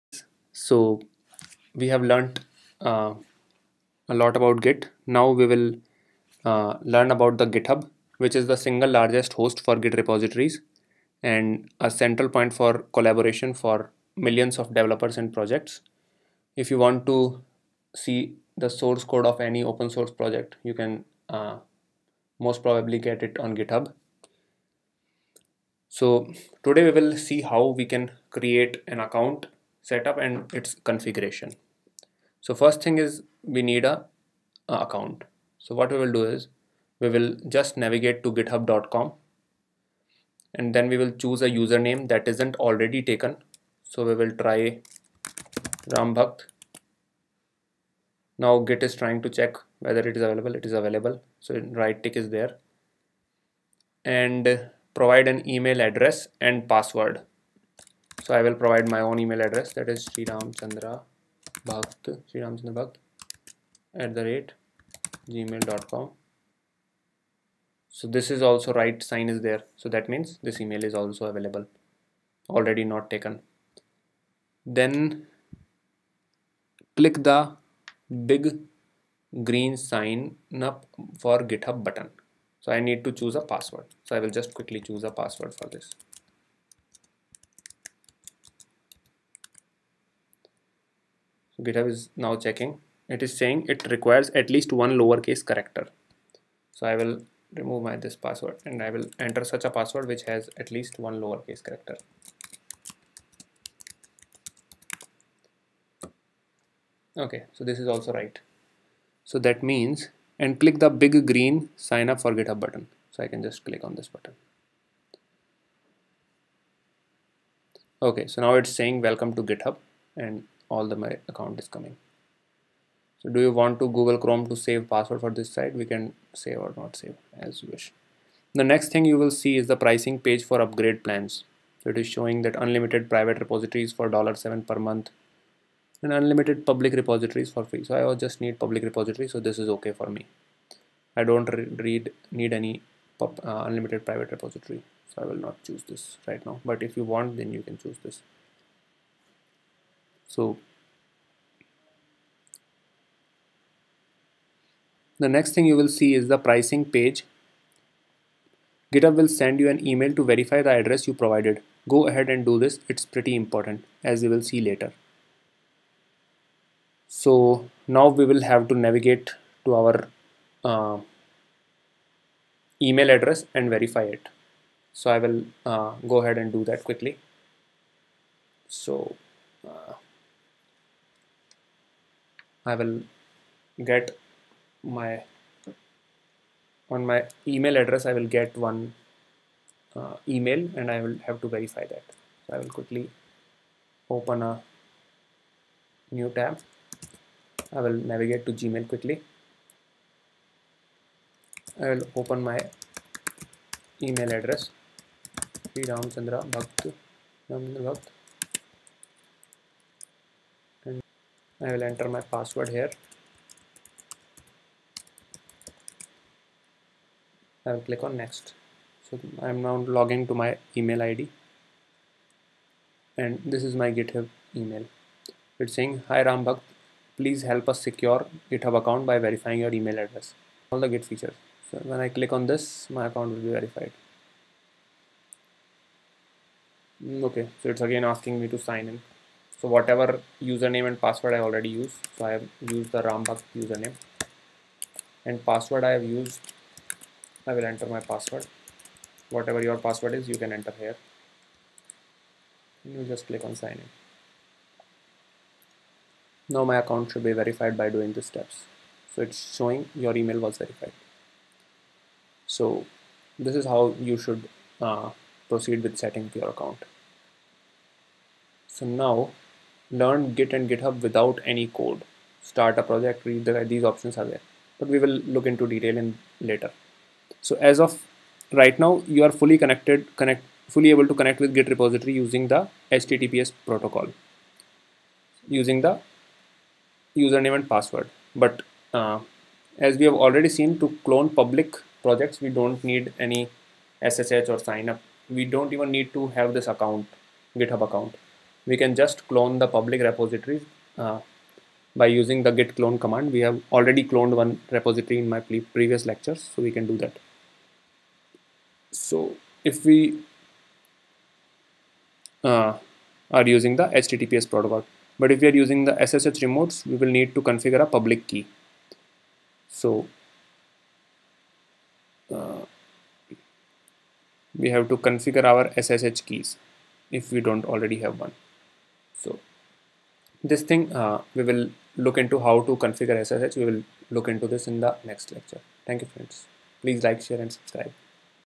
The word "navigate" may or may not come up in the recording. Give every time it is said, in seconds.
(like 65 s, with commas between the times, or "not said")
37 s, 168 s, 197 s.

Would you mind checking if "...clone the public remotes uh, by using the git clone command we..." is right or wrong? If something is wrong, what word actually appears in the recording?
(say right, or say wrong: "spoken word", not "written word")
wrong: "repositories", not "remotes".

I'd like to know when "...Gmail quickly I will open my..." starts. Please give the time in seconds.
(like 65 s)
198 s.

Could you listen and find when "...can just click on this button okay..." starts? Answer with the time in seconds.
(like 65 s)
113 s.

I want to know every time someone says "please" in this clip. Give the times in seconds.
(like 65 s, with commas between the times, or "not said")
227 s, 336 s.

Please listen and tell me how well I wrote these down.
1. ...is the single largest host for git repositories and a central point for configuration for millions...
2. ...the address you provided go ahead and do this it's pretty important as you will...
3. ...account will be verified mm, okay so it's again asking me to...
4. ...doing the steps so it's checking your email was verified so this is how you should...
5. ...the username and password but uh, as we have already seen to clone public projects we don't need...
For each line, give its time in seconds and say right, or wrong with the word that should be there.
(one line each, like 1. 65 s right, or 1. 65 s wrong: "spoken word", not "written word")
1. 8 s wrong: "collaboration", not "configuration"
2. 160 s right
3. 233 s right
4. 257 s wrong: "showing", not "checking"
5. 285 s right.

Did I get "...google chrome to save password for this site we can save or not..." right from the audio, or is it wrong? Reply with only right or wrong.
right.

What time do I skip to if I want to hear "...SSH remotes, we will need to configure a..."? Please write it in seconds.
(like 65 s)
315 s.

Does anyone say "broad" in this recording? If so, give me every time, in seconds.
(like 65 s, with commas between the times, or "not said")
not said.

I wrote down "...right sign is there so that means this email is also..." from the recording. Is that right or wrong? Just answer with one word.
right.